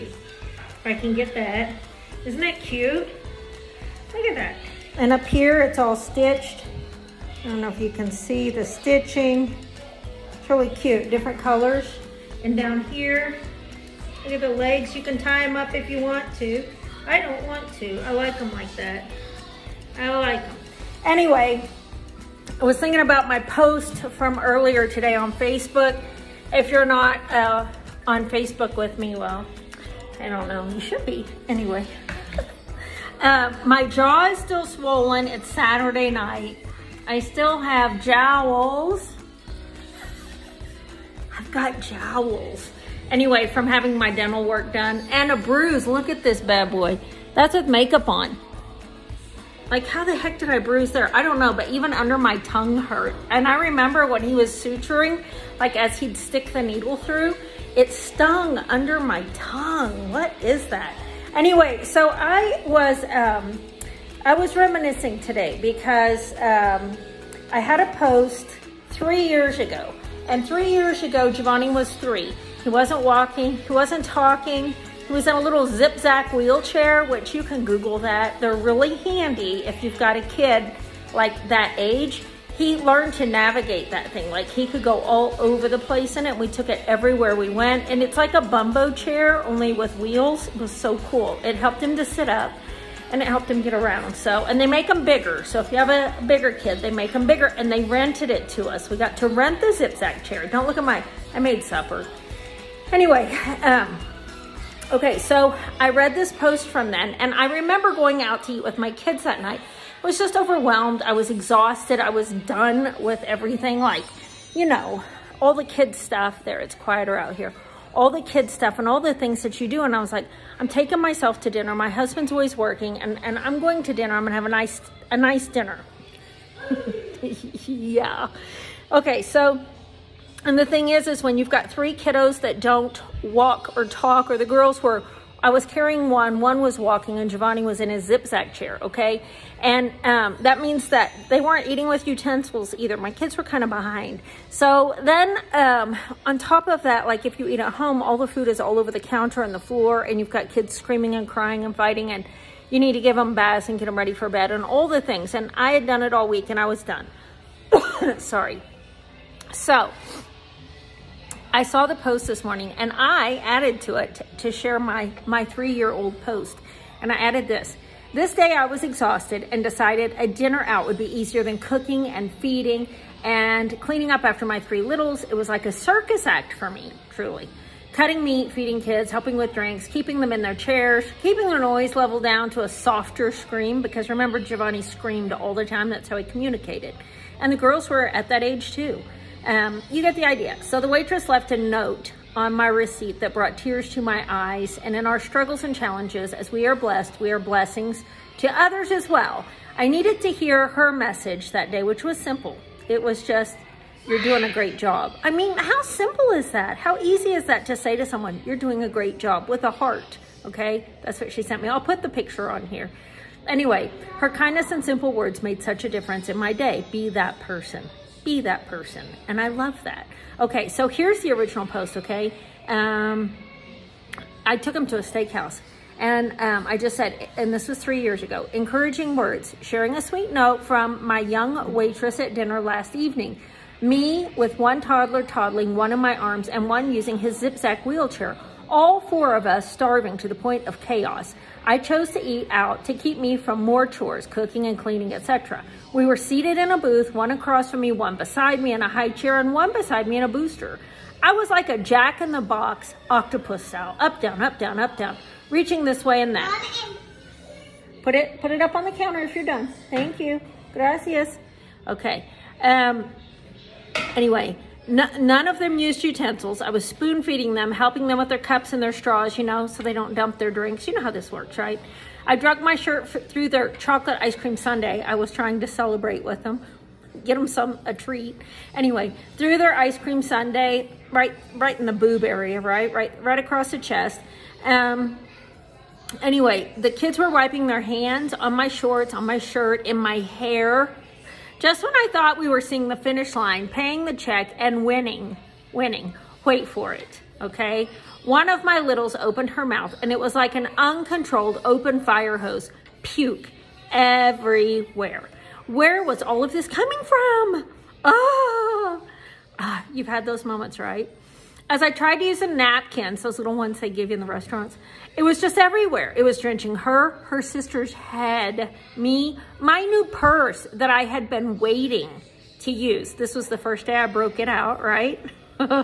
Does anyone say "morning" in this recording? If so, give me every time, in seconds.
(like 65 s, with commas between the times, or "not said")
162 s.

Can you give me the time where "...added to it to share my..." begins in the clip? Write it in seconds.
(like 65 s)
163 s.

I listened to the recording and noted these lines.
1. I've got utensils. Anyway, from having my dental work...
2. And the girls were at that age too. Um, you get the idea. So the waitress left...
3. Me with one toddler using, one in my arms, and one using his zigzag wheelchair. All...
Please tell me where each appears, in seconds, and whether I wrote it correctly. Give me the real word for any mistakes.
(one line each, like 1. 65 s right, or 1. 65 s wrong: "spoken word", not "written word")
1. 41 s wrong: "jowls", not "utensils"
2. 187 s right
3. 233 s wrong: "toddling", not "using".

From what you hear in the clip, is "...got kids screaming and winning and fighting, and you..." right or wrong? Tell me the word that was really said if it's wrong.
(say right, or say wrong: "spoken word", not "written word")
wrong: "crying", not "winning".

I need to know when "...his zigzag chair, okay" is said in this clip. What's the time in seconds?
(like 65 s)
137 s.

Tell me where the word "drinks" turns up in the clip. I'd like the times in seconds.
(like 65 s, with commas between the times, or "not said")
179 s, 270 s.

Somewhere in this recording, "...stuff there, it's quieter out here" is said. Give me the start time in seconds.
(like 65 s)
115 s.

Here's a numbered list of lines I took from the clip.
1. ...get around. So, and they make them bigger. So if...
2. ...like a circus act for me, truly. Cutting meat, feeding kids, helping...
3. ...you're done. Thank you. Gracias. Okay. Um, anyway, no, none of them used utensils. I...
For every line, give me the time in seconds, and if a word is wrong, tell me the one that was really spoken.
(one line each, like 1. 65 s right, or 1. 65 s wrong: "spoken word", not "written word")
1. 93 s right
2. 175 s right
3. 259 s right.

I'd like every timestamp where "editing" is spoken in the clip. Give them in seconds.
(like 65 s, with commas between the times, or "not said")
not said.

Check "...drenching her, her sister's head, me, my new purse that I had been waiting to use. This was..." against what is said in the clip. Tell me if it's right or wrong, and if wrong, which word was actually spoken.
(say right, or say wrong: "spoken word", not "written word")
right.